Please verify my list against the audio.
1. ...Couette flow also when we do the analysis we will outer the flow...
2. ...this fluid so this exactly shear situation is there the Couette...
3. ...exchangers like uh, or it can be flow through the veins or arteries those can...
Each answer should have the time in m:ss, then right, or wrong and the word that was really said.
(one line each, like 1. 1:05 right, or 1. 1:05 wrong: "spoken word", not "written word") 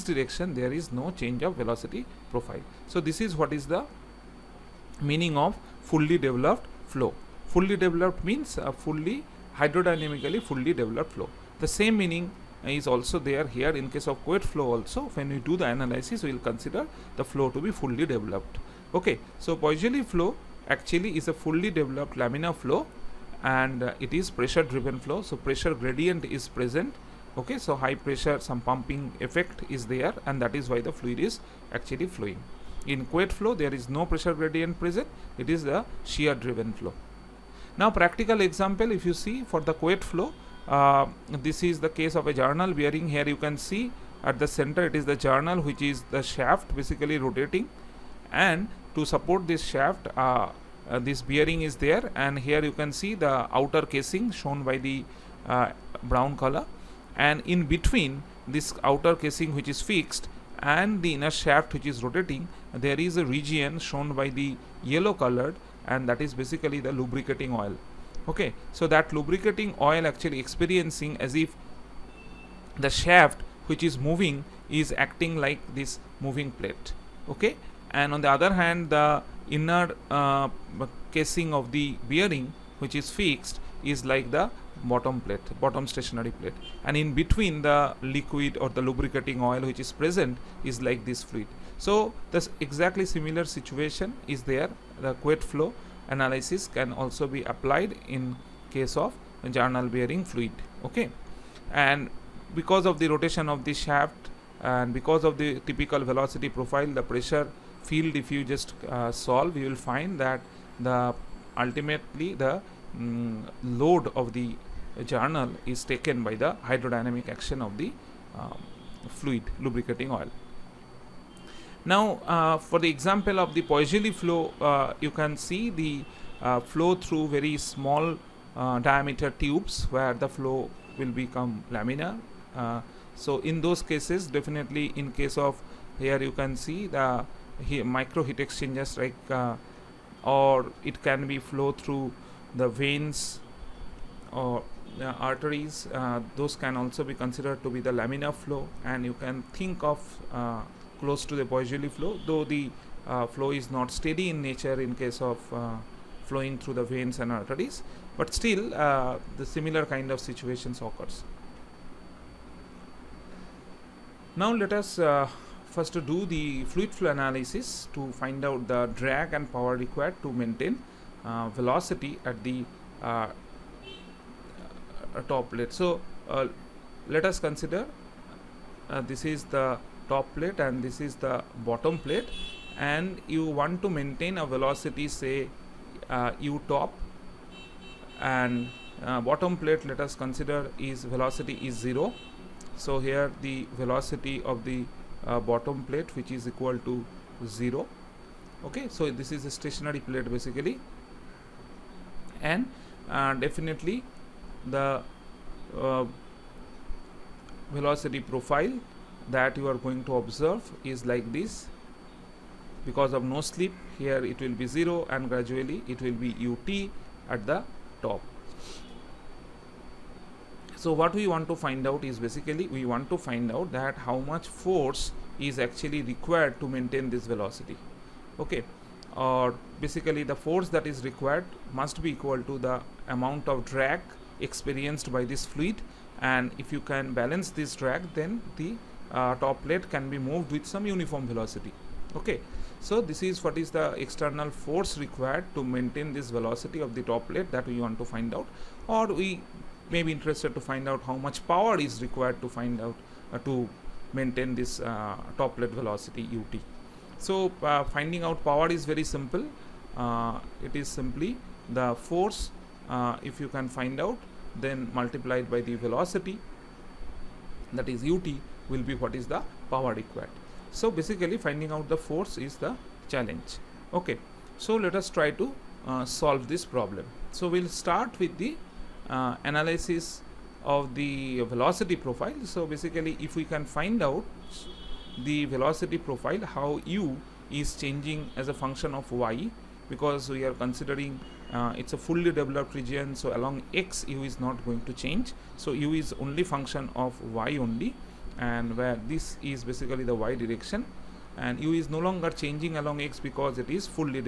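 1. 0:14 wrong: "consider", not "outer"
2. 1:31 wrong: "similar", not "shear"
3. 2:18 right.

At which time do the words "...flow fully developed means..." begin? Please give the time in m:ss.
0:06.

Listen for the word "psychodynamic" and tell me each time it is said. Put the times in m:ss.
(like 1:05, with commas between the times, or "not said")
not said.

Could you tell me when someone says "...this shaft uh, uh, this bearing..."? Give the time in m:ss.
0:49.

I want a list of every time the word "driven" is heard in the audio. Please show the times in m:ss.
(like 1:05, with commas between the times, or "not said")
0:24, 0:36.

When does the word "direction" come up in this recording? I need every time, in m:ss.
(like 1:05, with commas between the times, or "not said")
0:00, 5:00.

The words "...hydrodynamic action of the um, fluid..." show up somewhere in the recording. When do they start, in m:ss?
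1:56.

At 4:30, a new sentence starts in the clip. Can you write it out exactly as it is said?
So basically finding out the force is the challenge.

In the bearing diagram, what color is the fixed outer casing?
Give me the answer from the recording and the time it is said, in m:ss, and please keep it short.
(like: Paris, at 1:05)
Brown, at 0:56.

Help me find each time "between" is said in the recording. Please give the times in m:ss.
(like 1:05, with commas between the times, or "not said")
0:57, 1:27.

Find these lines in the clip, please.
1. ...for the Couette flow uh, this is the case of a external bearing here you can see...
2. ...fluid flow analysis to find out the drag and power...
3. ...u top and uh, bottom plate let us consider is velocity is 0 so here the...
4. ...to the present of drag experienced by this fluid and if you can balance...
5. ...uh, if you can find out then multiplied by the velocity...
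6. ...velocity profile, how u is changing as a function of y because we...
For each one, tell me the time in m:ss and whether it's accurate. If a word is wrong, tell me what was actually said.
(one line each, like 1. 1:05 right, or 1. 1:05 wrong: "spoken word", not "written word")
1. 0:39 wrong: "journal", not "external"
2. 2:46 right
3. 3:06 right
4. 3:52 wrong: "amount", not "present"
5. 4:22 right
6. 4:45 right.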